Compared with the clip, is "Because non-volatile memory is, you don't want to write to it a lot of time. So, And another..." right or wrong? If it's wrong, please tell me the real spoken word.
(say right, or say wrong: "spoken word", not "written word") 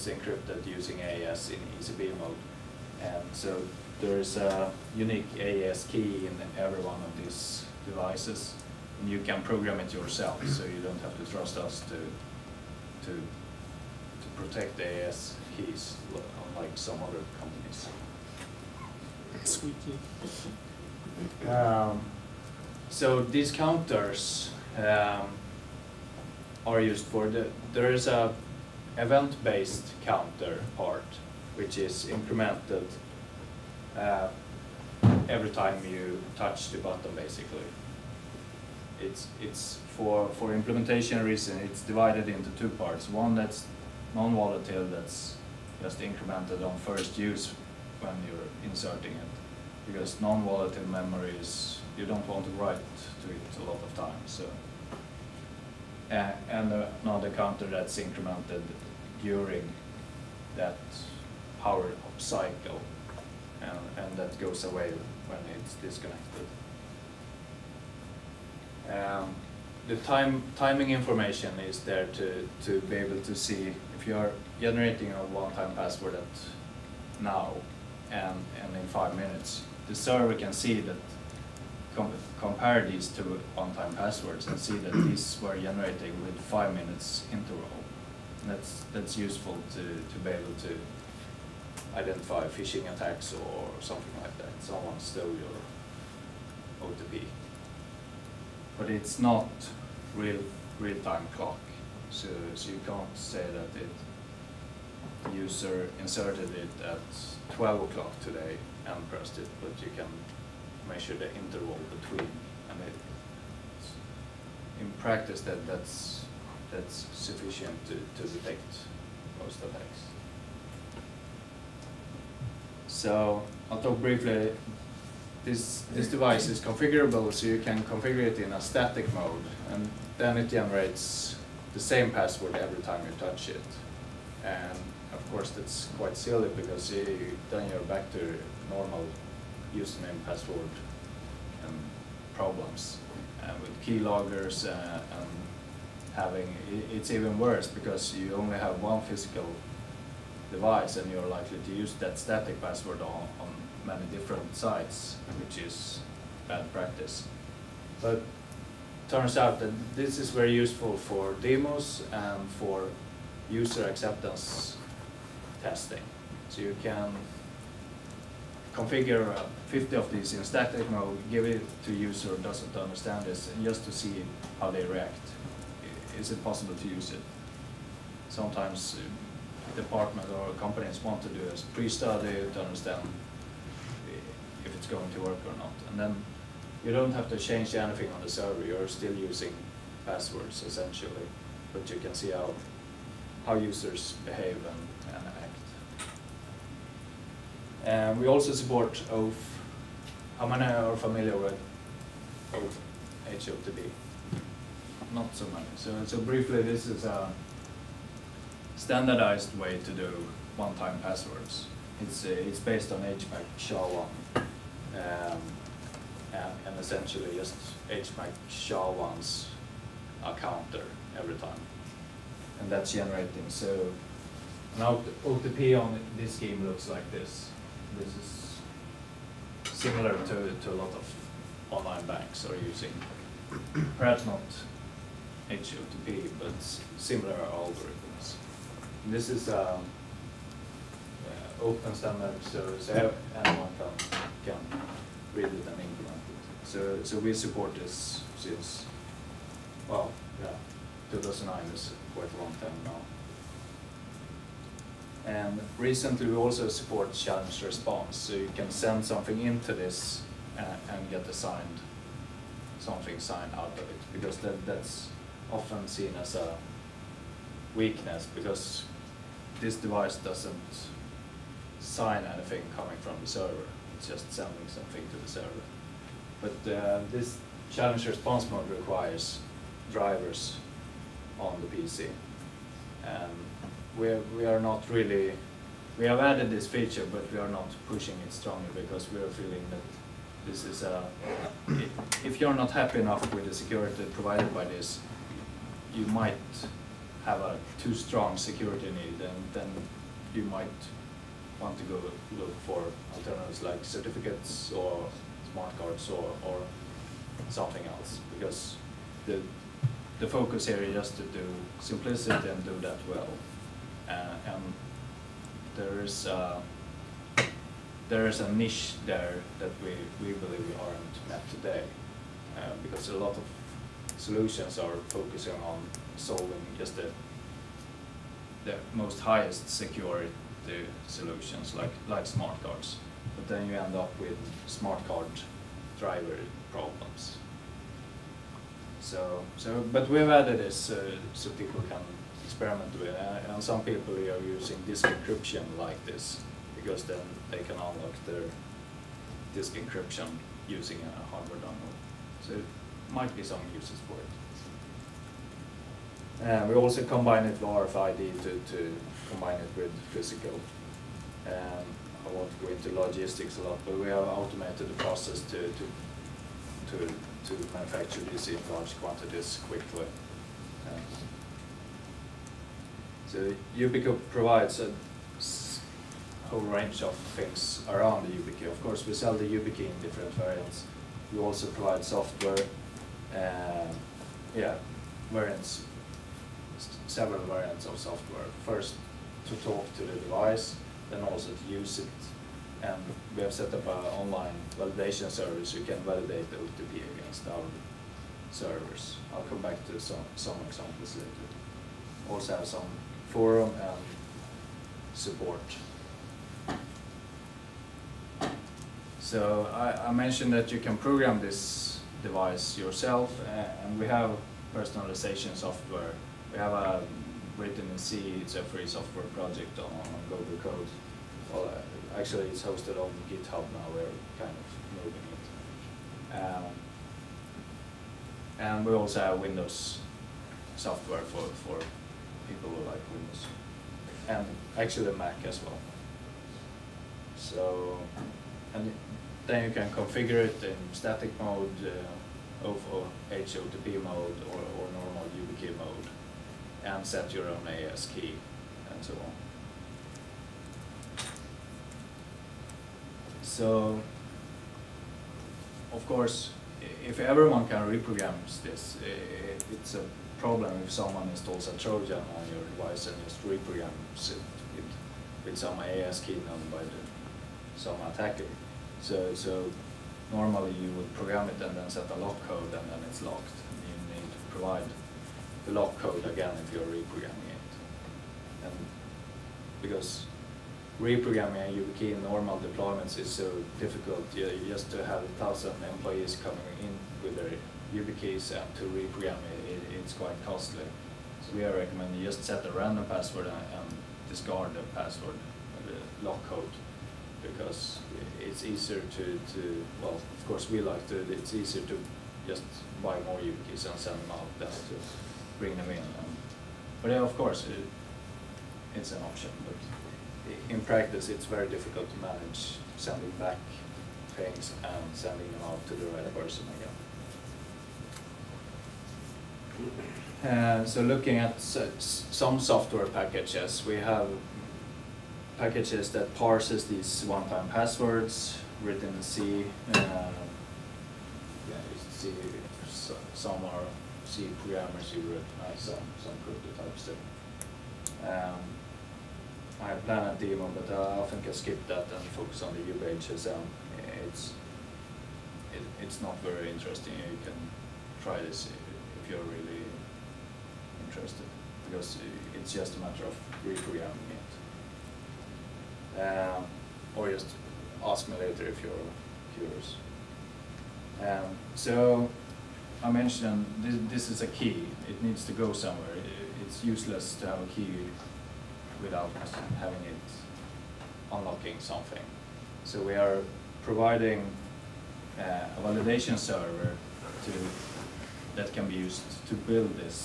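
right.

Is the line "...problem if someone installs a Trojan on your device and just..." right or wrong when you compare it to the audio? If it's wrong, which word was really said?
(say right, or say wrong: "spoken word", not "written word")
right.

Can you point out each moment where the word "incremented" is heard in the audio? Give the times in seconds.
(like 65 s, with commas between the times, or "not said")
32 s, 45 s, 57 s.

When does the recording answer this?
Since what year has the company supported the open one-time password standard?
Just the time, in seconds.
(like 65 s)
251 s.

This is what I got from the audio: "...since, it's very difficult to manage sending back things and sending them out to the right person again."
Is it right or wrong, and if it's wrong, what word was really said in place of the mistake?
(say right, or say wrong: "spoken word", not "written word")
wrong: "practice", not "since".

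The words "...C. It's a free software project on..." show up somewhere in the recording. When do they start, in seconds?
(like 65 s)
417 s.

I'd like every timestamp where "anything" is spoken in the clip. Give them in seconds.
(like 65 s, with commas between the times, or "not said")
187 s, 272 s.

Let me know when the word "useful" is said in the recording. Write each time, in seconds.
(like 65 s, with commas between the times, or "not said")
89 s, 160 s.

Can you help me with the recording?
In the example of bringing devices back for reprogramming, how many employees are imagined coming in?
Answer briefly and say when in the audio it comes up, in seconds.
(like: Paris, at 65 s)
a thousand, at 485 s.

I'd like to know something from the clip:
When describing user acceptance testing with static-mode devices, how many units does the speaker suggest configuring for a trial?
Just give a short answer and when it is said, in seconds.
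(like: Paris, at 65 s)
50, at 169 s.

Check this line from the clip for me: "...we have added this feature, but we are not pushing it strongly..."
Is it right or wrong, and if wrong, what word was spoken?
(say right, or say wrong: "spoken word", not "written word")
right.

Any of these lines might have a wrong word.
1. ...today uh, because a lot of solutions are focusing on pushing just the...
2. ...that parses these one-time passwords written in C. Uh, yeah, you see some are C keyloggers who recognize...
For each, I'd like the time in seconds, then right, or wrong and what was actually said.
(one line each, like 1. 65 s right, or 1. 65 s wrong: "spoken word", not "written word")
1. 321 s wrong: "solving", not "pushing"
2. 526 s wrong: "programmers", not "keyloggers".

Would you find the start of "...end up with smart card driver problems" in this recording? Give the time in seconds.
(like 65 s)
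333 s.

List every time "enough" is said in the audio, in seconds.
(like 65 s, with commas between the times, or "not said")
292 s.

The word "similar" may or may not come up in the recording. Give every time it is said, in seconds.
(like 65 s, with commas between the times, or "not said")
229 s, 236 s.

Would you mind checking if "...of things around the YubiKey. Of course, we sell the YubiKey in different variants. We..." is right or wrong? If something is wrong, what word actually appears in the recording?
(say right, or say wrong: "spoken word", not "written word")
right.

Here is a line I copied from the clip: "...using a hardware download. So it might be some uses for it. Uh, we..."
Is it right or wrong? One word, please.
right.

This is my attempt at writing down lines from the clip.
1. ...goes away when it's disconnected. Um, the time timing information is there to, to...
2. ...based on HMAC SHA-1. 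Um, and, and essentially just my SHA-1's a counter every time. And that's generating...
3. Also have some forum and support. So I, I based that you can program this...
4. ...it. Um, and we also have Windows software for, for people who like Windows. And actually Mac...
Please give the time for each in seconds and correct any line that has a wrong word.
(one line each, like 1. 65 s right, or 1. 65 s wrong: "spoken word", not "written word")
1. 64 s right
2. 212 s right
3. 402 s wrong: "mentioned", not "based"
4. 426 s right.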